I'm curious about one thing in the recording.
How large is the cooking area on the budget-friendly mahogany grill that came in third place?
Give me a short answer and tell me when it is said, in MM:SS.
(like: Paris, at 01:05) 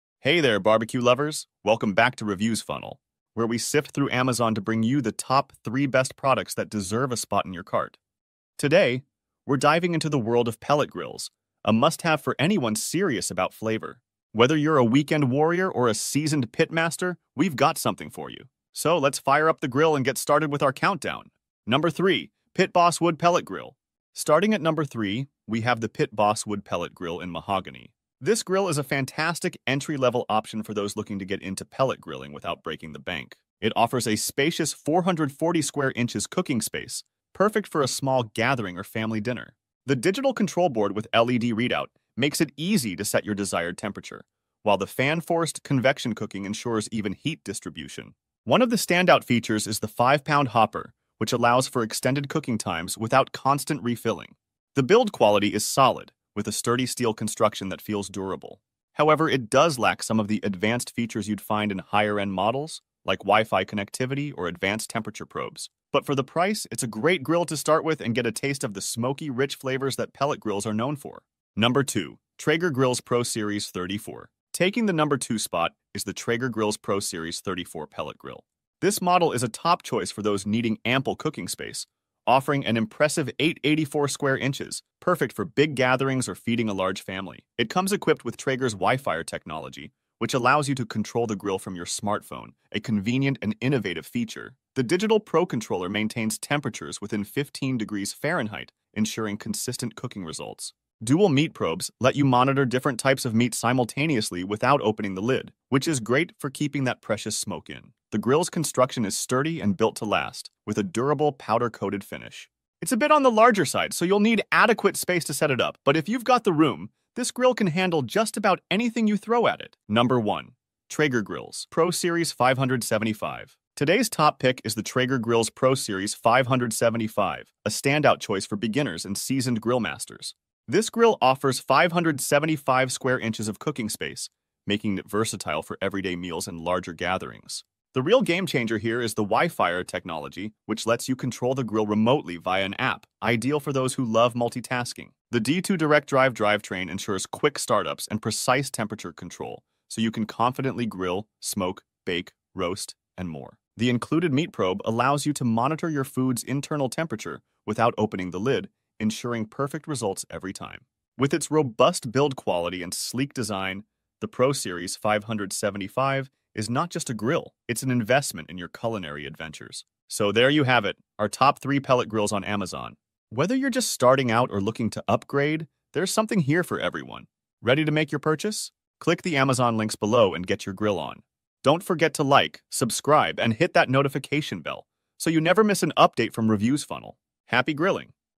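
440 square inches, at 00:34.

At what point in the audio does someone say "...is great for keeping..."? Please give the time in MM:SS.
01:45.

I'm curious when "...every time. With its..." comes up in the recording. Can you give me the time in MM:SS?
02:40.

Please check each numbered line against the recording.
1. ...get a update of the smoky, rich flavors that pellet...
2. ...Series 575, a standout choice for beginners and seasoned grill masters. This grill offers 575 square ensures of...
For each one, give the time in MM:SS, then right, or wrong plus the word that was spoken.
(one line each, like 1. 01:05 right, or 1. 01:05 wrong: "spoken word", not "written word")
1. 01:08 wrong: "taste", not "update"
2. 02:05 wrong: "inches", not "ensures".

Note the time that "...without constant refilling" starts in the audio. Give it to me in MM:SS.
00:52.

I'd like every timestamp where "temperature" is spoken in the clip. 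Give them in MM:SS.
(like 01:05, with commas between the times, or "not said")
00:43, 01:04, 01:36, 02:28, 02:36.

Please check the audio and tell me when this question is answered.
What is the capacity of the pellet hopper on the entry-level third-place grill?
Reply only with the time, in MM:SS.
00:49.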